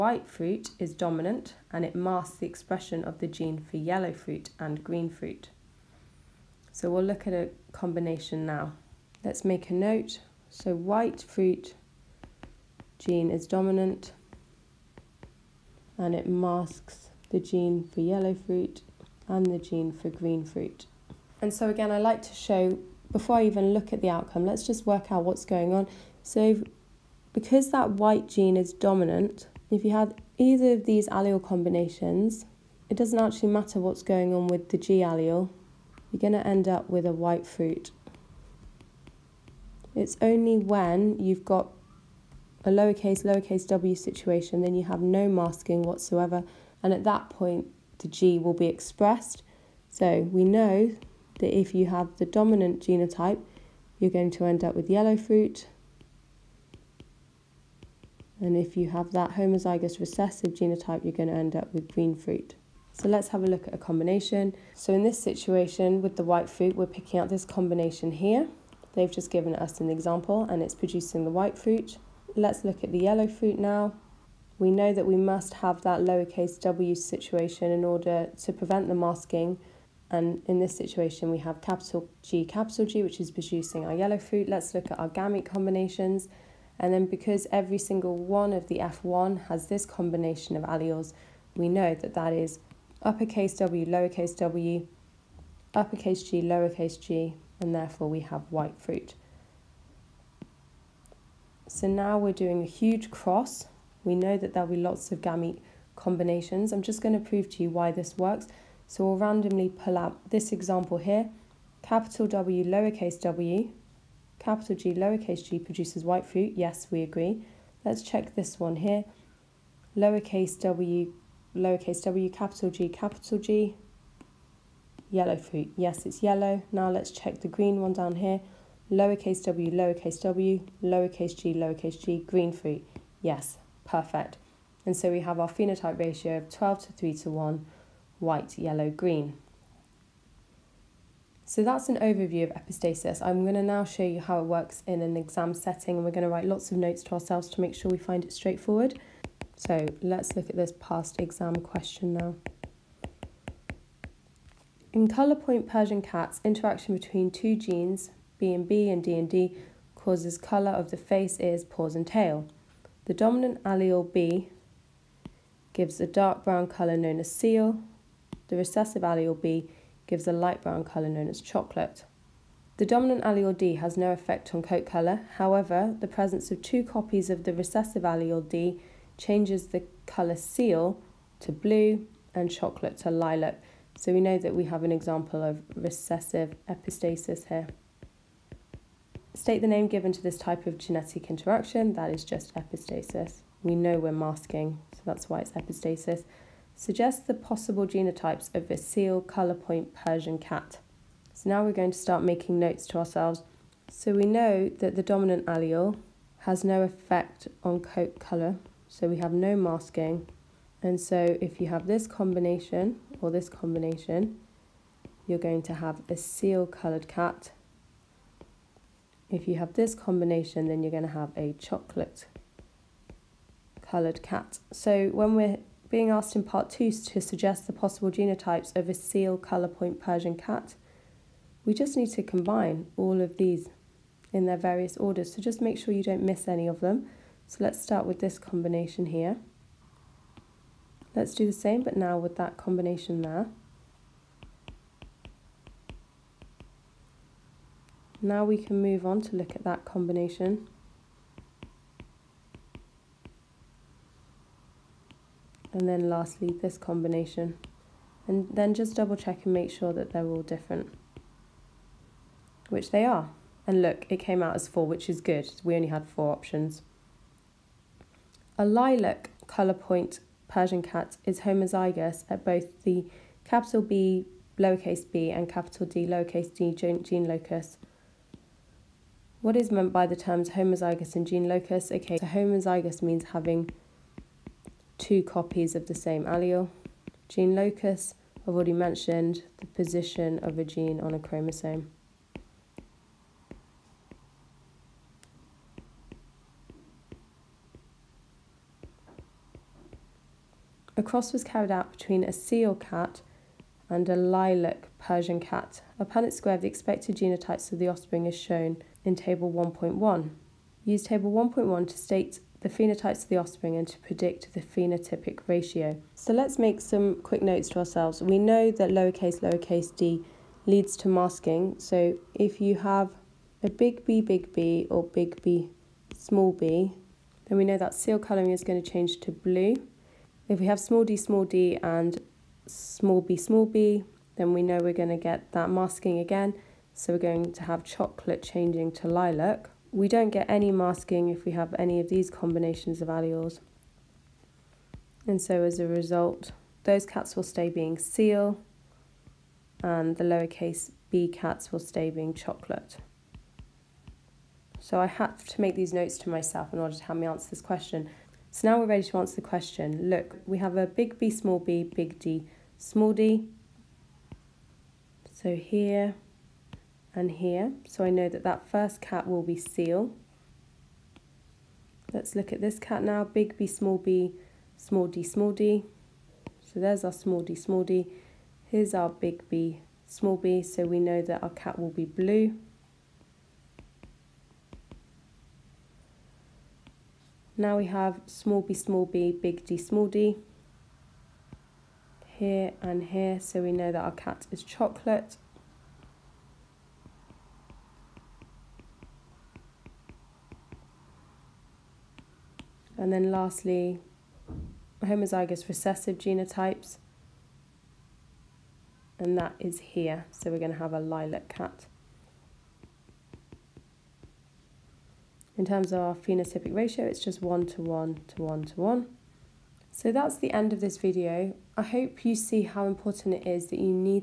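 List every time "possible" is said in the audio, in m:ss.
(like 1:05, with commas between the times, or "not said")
3:17, 3:47.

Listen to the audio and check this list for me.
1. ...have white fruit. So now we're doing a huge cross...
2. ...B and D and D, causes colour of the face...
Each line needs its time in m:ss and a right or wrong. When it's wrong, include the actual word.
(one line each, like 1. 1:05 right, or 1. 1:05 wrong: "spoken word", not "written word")
1. 1:38 right
2. 2:38 right.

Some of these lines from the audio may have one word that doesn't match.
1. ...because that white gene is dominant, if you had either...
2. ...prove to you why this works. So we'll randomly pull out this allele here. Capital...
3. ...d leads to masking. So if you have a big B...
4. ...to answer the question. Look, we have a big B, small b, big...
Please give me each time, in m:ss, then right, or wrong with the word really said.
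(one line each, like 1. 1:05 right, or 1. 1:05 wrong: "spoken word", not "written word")
1. 0:27 right
2. 1:47 wrong: "example", not "allele"
3. 5:19 right
4. 5:59 right.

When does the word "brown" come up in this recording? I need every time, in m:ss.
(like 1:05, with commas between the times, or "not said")
2:46, 2:50.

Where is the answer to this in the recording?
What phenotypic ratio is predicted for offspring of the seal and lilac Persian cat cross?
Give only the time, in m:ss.
6:57.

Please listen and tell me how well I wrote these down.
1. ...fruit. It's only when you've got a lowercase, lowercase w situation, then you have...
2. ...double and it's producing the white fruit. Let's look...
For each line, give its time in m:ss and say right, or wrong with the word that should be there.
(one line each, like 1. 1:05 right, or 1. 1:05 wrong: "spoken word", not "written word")
1. 0:37 right
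2. 1:09 wrong: "example", not "double".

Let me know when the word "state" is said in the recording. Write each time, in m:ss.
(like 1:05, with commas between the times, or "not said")
3:09, 5:11.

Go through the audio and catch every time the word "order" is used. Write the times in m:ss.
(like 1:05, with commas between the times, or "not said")
1:17, 3:54, 5:56.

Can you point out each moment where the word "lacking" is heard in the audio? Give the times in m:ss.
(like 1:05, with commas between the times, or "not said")
not said.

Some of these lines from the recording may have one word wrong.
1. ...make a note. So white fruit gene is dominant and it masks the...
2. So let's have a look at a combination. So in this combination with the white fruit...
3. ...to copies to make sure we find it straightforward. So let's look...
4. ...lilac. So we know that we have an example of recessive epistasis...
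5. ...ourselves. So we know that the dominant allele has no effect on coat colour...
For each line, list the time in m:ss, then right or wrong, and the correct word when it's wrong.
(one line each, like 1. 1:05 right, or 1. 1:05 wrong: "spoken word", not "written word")
1. 0:09 right
2. 1:02 wrong: "situation", not "combination"
3. 2:27 wrong: "ourselves", not "copies"
4. 3:03 right
5. 3:22 right.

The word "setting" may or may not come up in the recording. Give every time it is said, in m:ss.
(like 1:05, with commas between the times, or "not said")
2:25.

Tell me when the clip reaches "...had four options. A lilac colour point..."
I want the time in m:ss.
4:25.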